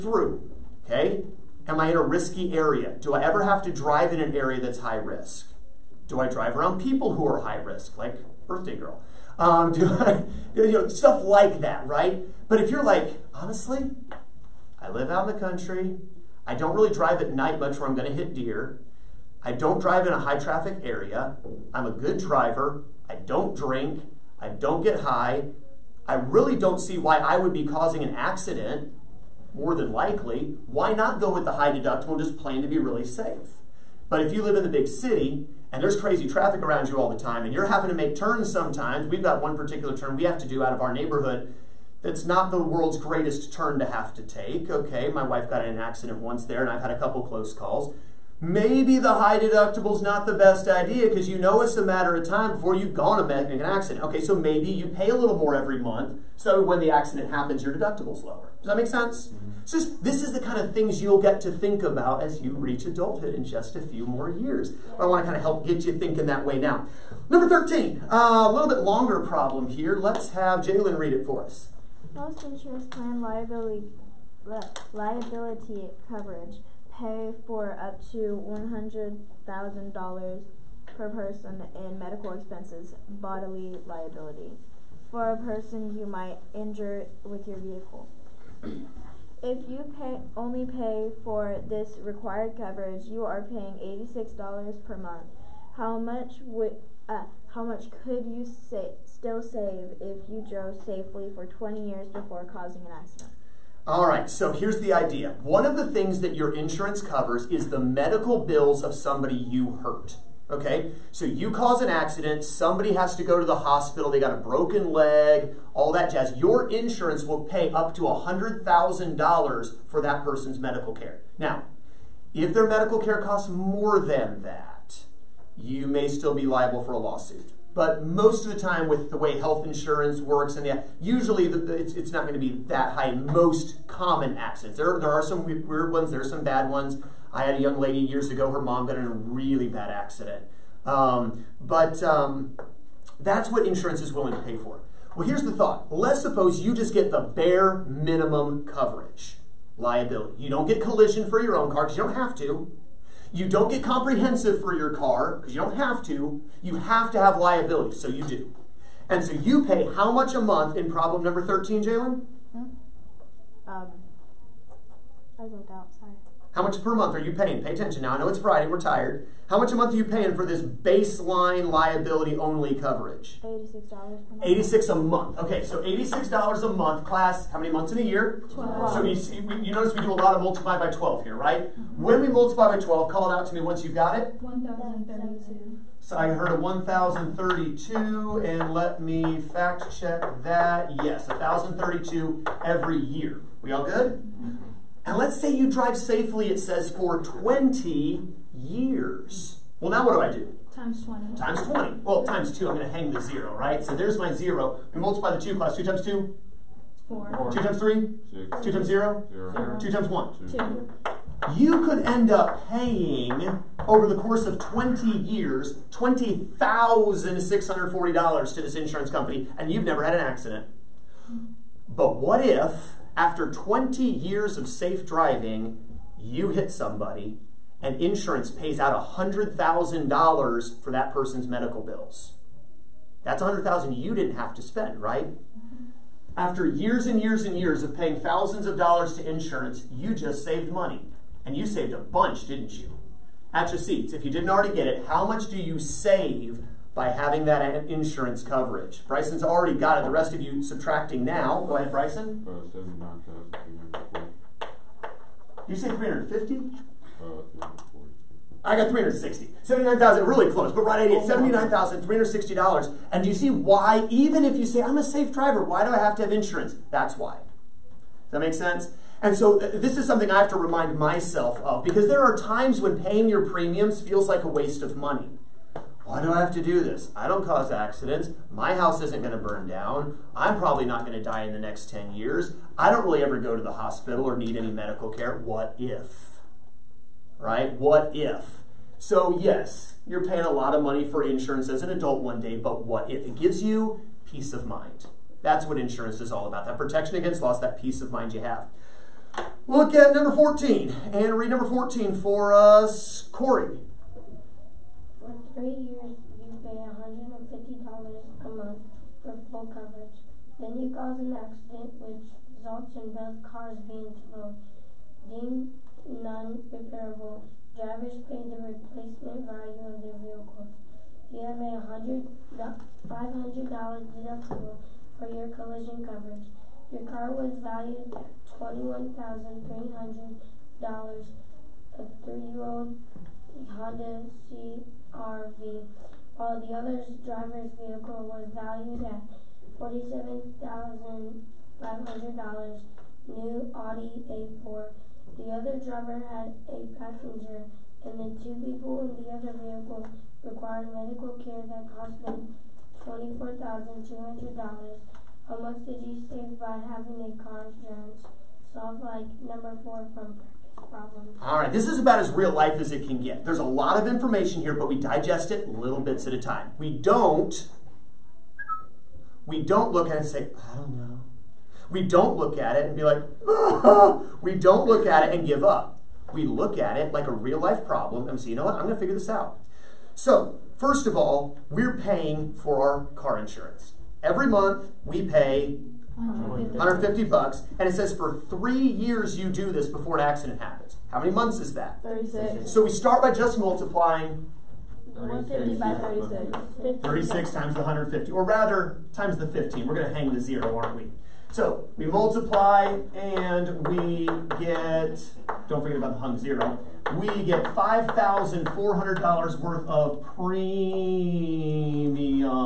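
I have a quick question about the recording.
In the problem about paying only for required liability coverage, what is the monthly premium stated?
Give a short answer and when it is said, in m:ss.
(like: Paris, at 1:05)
$86, at 1:34.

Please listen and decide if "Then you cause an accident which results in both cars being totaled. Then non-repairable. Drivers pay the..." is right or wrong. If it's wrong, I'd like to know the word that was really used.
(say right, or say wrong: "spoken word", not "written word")
right.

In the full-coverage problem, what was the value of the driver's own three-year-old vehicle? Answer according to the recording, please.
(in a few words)
$21,300.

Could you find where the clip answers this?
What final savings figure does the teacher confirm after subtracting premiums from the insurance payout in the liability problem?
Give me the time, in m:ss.
4:21.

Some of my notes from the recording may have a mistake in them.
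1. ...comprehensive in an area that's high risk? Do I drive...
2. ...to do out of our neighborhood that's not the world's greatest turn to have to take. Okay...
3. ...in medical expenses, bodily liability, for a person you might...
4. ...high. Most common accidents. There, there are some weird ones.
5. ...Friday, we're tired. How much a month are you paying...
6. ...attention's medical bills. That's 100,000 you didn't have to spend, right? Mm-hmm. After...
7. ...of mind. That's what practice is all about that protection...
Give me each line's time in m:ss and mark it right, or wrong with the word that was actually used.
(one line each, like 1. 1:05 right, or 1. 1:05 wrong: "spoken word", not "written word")
1. 0:03 wrong: "drive", not "comprehensive"
2. 0:40 right
3. 1:21 right
4. 2:12 right
5. 2:48 right
6. 3:51 wrong: "person", not "attention"
7. 4:54 wrong: "insurance", not "practice".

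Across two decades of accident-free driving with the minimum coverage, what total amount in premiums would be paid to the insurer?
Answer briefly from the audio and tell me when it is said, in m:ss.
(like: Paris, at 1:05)
$20,640, at 3:35.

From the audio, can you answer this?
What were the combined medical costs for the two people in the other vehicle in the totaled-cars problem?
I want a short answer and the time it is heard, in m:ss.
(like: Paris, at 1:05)
$24,200, at 5:53.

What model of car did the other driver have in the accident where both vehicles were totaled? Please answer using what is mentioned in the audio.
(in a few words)
Audi A4.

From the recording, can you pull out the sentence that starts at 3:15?
And let's say you drive safely, it says for 20 years.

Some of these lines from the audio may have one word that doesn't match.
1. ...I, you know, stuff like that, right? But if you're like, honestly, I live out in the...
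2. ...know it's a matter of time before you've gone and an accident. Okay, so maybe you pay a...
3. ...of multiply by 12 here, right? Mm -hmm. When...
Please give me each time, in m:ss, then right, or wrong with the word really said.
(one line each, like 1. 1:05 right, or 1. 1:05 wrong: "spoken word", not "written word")
1. 0:09 right
2. 0:51 right
3. 3:00 right.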